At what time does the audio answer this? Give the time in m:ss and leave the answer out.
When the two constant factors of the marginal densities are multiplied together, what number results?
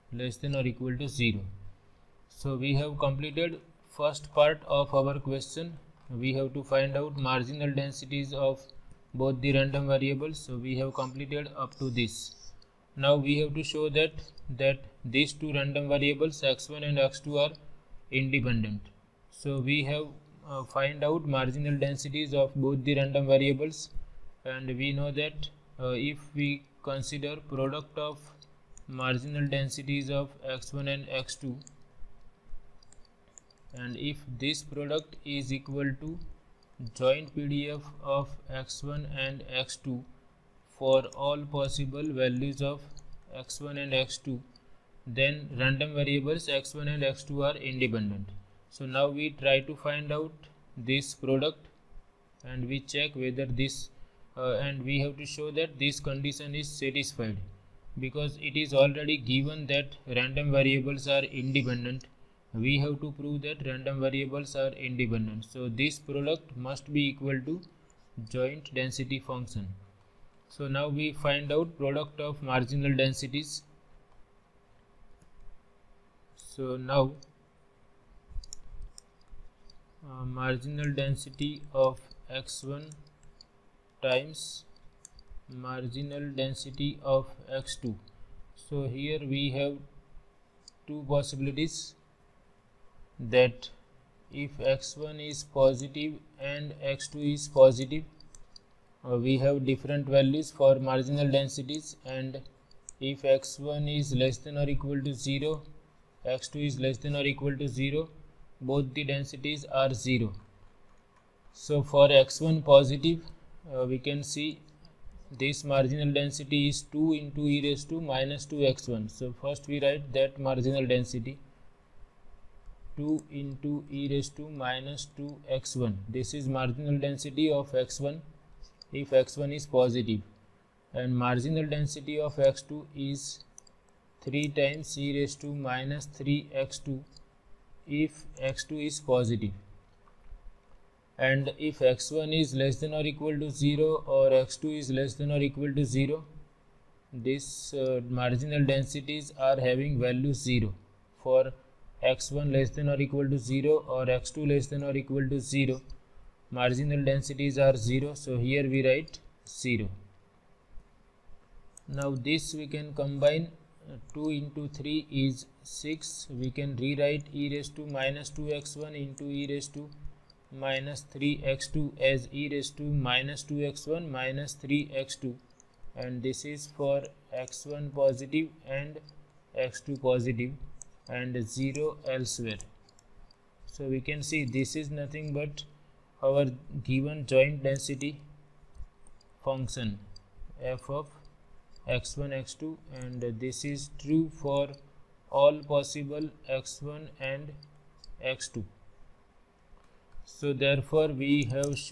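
2:45.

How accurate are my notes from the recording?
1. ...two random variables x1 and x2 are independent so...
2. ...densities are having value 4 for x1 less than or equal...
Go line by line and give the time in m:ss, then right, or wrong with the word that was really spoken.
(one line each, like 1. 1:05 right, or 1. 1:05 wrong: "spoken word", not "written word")
1. 0:15 right
2. 2:28 wrong: "0", not "4".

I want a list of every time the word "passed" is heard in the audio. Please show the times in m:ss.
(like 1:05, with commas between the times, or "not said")
not said.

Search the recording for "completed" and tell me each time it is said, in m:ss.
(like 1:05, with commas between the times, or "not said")
0:02, 0:10.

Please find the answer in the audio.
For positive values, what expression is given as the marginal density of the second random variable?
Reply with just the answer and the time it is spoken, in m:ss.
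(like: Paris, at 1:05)
3e^(-3x2), at 2:14.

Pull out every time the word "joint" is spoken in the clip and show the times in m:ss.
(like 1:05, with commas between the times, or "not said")
0:36, 1:08, 3:07.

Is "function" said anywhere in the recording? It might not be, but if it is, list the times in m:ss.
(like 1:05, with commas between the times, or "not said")
1:09, 3:09.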